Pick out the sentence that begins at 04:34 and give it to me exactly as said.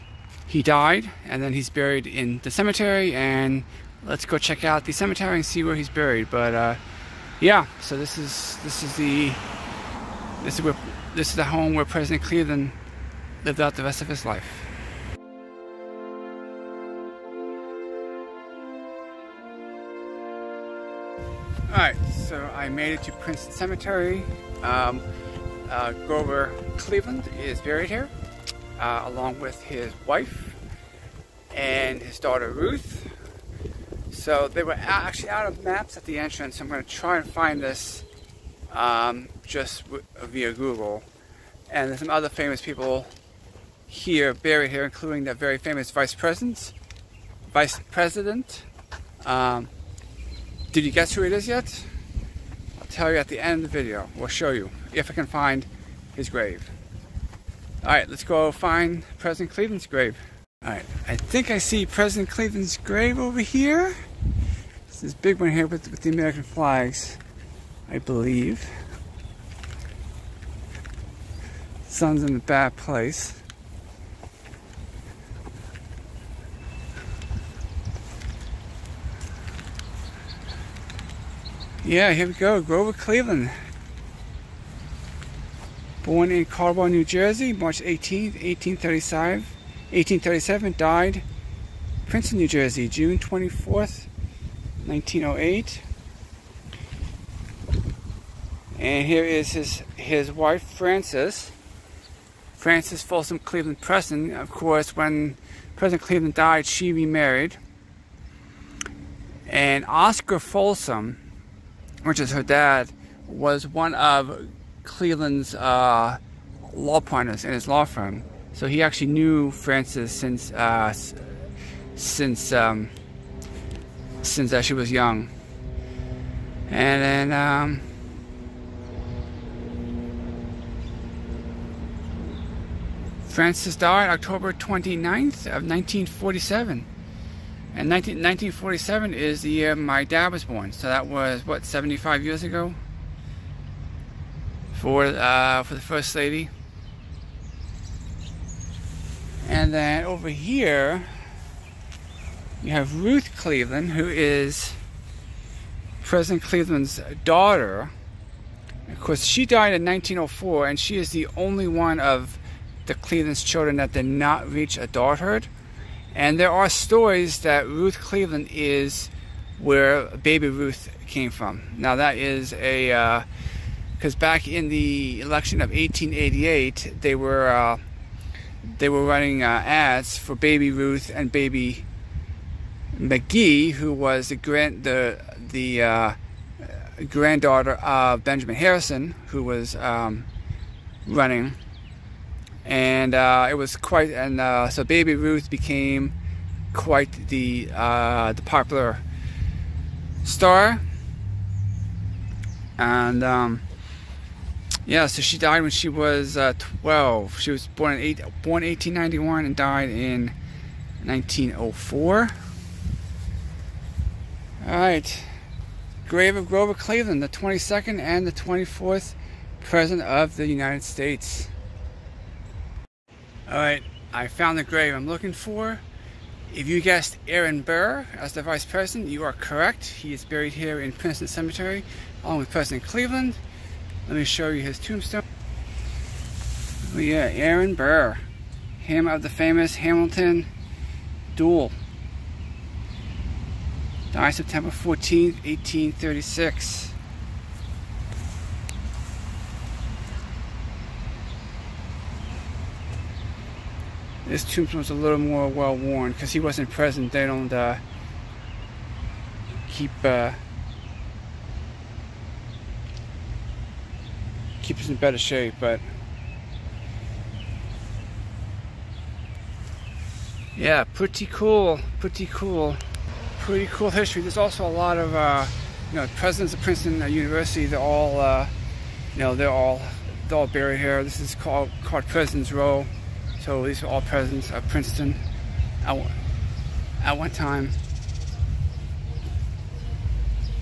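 There's also a lot of uh, you know presidents of Princeton uh, University.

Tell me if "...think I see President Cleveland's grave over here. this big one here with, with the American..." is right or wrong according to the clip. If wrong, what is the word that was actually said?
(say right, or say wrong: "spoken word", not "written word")
right.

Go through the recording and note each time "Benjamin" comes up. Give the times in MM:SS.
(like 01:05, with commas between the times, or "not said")
03:08.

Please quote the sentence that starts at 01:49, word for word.
And Oscar Folsom, which is her dad, was one of Cleveland's uh, law partners in his law firm.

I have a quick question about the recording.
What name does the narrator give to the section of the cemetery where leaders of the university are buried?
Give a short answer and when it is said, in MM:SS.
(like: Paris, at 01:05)
President's Row, at 04:42.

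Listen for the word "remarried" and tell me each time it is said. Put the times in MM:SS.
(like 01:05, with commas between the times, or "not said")
01:46.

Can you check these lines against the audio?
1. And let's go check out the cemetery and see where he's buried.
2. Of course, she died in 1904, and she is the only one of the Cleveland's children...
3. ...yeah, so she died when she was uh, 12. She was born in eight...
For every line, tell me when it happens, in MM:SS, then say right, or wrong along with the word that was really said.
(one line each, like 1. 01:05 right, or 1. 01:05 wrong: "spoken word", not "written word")
1. 00:03 right
2. 02:38 right
3. 03:24 right.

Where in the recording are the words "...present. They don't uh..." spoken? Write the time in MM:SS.
04:16.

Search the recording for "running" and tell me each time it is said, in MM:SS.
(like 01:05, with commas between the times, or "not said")
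02:59, 03:11.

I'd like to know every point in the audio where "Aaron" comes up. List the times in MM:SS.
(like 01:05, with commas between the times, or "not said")
03:47, 03:57.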